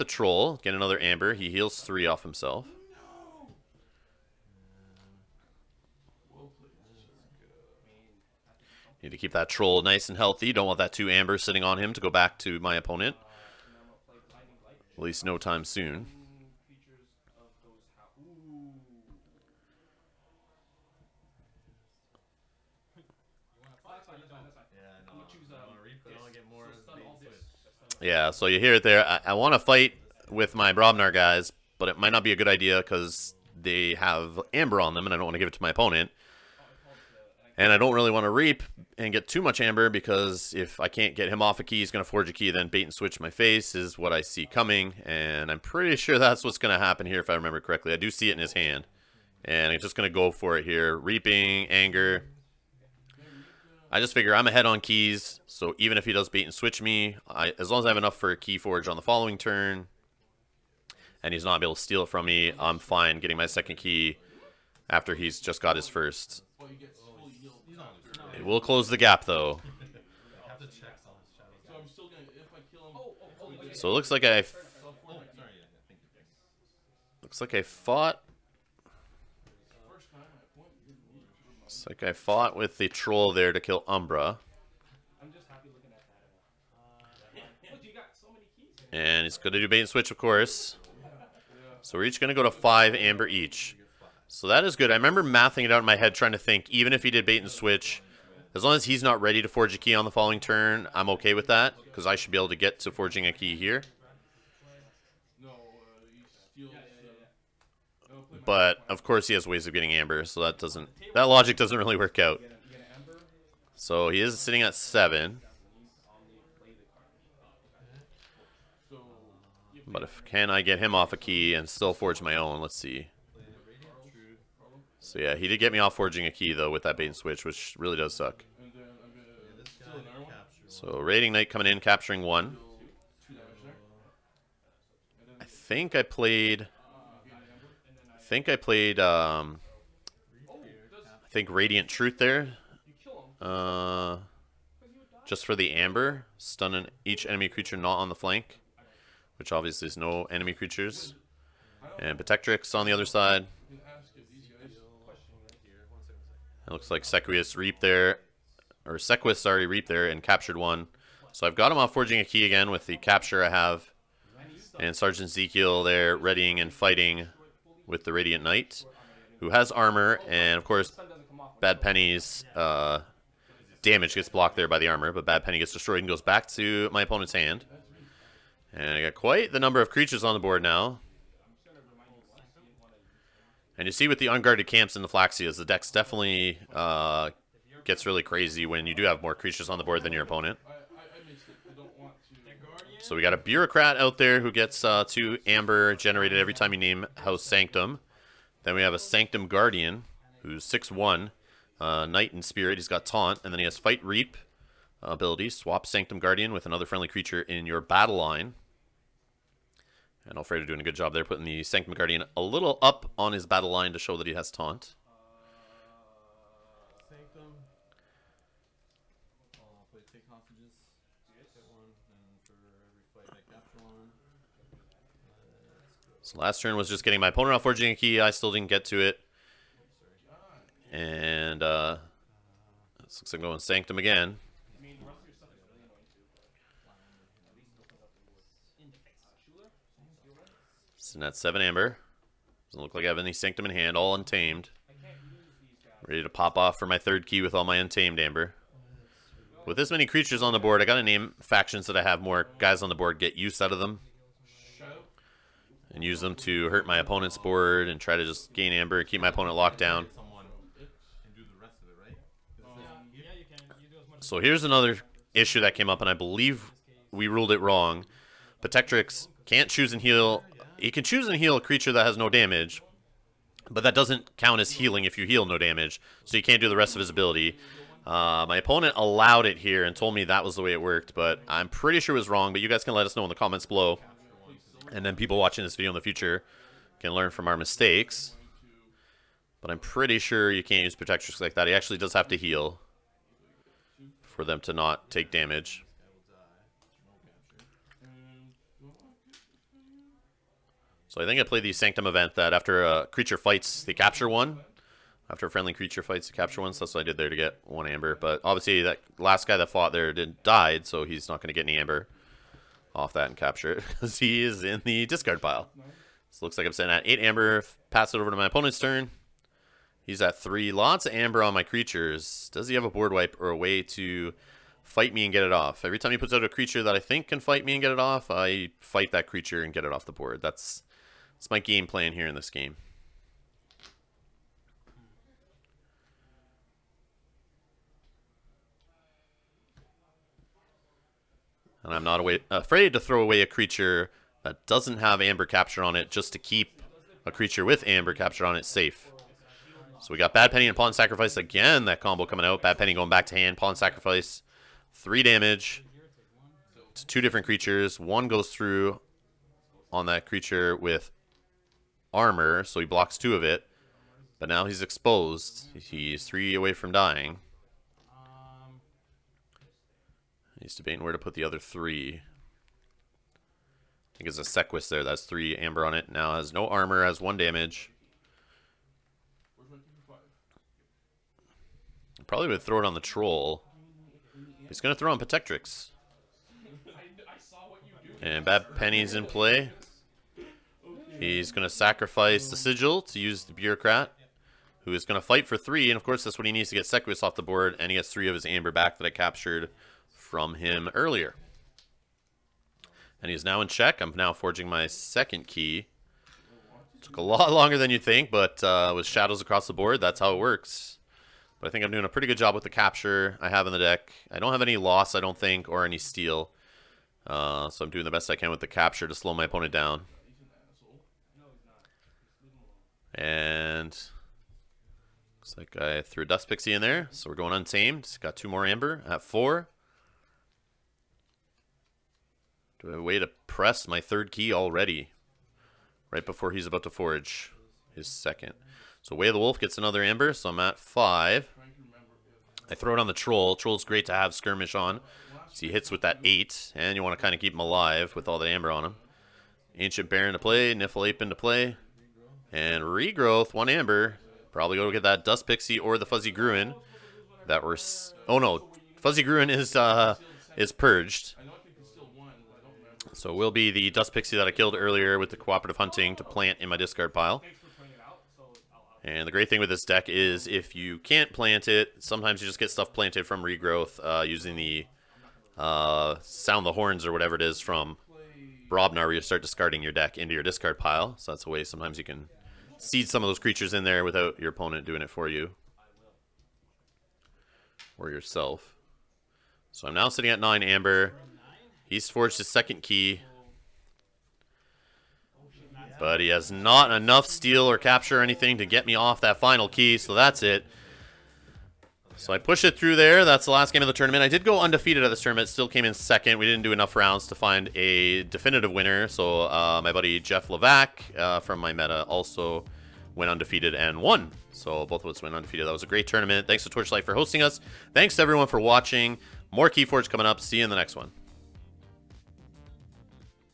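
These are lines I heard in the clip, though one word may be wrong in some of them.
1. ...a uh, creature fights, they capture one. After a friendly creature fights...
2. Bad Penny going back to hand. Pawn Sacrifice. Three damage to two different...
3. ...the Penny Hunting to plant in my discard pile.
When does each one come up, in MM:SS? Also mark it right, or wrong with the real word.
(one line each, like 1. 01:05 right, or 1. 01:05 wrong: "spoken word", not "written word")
1. 05:02 right
2. 05:52 right
3. 07:45 wrong: "Cooperative", not "Penny".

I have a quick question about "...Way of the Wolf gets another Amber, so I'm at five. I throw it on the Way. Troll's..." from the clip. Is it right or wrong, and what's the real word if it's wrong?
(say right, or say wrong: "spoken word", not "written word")
wrong: "Troll", not "Way".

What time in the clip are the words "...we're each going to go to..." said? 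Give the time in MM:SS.
01:31.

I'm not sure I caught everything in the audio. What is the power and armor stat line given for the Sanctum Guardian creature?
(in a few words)
6-1.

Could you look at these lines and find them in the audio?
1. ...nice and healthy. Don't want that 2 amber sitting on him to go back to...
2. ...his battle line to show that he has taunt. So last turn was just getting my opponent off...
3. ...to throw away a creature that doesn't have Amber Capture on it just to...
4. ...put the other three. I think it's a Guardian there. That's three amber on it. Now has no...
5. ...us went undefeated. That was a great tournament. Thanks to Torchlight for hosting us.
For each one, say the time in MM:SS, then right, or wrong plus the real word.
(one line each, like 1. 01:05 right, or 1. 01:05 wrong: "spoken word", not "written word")
1. 00:09 right
2. 03:33 right
3. 05:42 right
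4. 06:11 wrong: "Sequus", not "Guardian"
5. 08:35 right.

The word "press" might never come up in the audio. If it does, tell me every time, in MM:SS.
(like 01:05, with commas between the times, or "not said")
07:13.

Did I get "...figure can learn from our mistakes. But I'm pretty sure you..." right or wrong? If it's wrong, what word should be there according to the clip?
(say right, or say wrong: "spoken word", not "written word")
wrong: "future", not "figure".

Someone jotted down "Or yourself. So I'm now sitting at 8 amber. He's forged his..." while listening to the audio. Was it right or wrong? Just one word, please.
wrong.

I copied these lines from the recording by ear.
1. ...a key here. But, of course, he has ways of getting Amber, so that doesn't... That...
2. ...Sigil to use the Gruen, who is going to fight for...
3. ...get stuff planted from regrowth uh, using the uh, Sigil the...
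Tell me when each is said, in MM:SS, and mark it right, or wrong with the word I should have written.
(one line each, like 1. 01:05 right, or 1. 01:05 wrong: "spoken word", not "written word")
1. 01:43 right
2. 06:32 wrong: "Bureaucrat", not "Gruen"
3. 07:52 wrong: "Sound", not "Sigil".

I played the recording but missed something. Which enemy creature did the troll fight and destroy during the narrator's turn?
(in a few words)
Umbra.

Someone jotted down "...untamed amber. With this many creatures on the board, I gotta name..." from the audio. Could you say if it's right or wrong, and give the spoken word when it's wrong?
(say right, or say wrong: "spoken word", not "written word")
right.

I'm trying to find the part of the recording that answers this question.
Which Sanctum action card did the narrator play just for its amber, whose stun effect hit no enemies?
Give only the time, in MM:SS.
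02:21.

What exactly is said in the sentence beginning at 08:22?
So I push it through there.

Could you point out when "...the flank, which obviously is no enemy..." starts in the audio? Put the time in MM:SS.
02:28.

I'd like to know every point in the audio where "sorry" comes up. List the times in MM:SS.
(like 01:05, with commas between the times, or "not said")
02:39.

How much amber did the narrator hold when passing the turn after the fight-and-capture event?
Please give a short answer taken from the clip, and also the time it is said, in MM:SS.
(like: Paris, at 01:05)
8, at 05:17.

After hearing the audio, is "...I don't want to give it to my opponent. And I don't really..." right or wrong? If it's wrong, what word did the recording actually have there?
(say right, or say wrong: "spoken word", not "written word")
right.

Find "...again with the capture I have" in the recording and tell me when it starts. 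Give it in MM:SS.
02:42.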